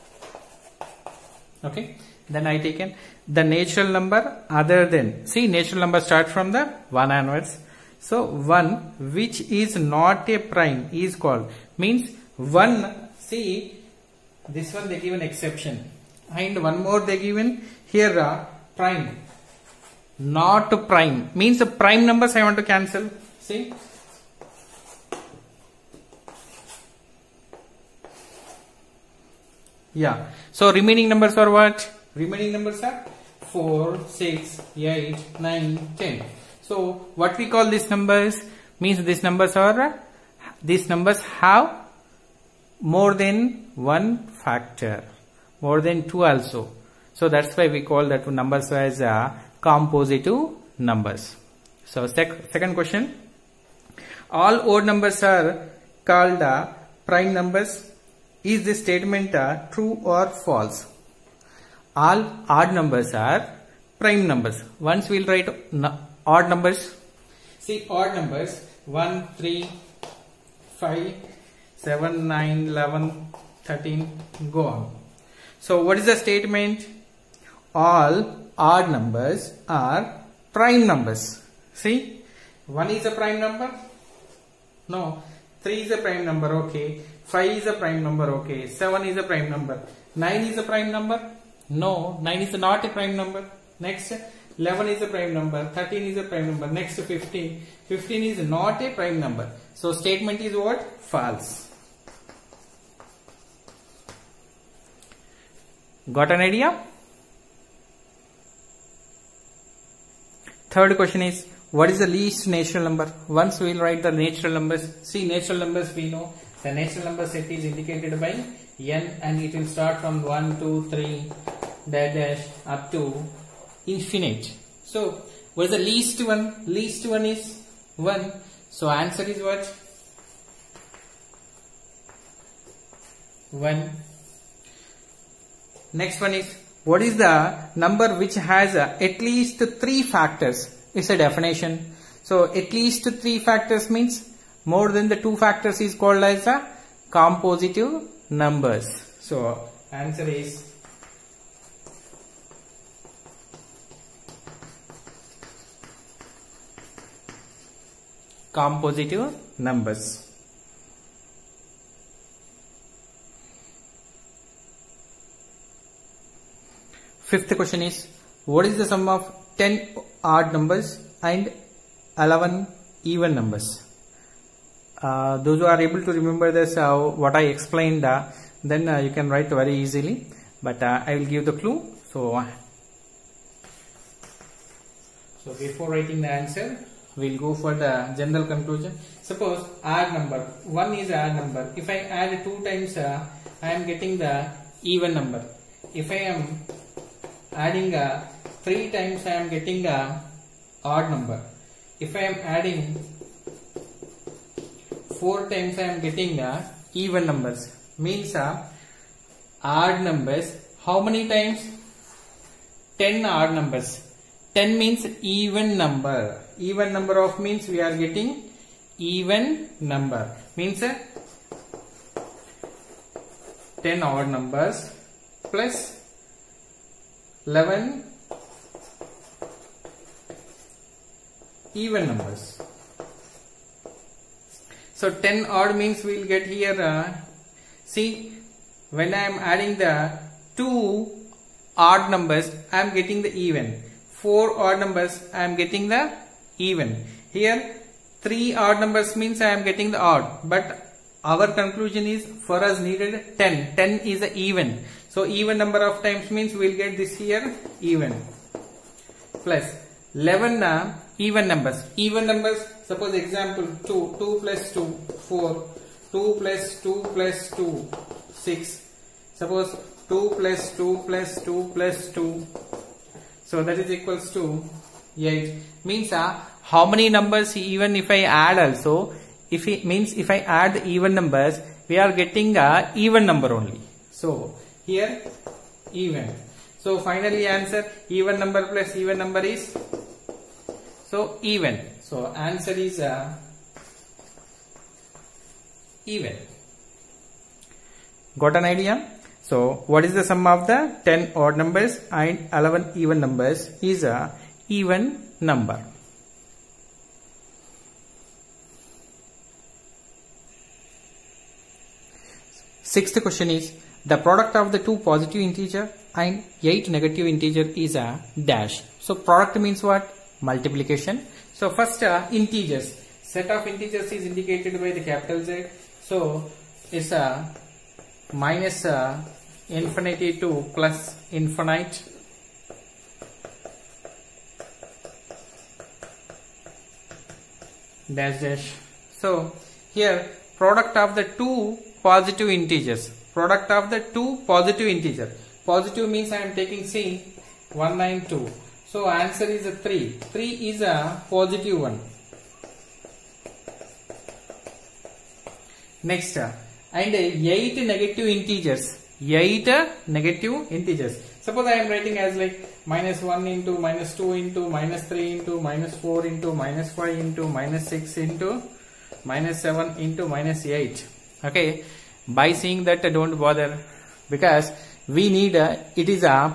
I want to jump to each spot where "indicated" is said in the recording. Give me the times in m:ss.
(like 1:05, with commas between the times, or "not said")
1:57, 5:24.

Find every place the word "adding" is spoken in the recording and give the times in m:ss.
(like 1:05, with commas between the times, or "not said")
3:17, 3:22, 3:59.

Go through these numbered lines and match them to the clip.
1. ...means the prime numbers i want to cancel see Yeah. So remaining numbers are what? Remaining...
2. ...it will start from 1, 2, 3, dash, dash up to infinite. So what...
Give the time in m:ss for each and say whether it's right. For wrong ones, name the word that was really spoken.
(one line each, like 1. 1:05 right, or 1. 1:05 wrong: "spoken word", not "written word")
1. 0:21 right
2. 1:59 right.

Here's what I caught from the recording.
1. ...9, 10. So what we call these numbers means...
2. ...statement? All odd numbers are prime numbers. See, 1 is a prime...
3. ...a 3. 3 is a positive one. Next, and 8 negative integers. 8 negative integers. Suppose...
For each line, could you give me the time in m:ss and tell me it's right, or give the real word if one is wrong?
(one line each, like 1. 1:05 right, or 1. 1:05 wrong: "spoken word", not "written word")
1. 0:35 right
2. 1:16 right
3. 5:49 right.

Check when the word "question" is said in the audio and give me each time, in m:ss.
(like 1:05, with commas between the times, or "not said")
0:52, 1:50, 2:47, 5:13.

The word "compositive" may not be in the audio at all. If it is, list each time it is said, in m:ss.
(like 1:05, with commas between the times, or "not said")
0:49, 2:27, 2:38.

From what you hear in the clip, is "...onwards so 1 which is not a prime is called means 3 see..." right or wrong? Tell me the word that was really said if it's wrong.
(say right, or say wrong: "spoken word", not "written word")
wrong: "1", not "3".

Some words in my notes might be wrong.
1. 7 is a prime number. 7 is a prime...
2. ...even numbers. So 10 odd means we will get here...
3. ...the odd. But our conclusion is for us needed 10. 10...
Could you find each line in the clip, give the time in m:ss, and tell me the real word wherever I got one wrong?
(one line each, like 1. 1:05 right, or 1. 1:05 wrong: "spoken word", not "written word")
1. 1:28 wrong: "9", not "7"
2. 3:51 right
3. 4:09 right.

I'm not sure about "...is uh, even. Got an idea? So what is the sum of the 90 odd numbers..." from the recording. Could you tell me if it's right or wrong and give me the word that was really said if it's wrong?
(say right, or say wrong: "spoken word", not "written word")
wrong: "10", not "90".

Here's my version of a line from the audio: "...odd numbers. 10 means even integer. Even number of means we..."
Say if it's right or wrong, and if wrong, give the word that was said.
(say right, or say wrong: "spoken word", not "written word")
wrong: "number", not "integer".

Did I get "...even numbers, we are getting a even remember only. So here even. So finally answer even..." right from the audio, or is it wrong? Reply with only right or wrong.
wrong.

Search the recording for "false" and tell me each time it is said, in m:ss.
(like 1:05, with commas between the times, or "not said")
1:00, 1:41.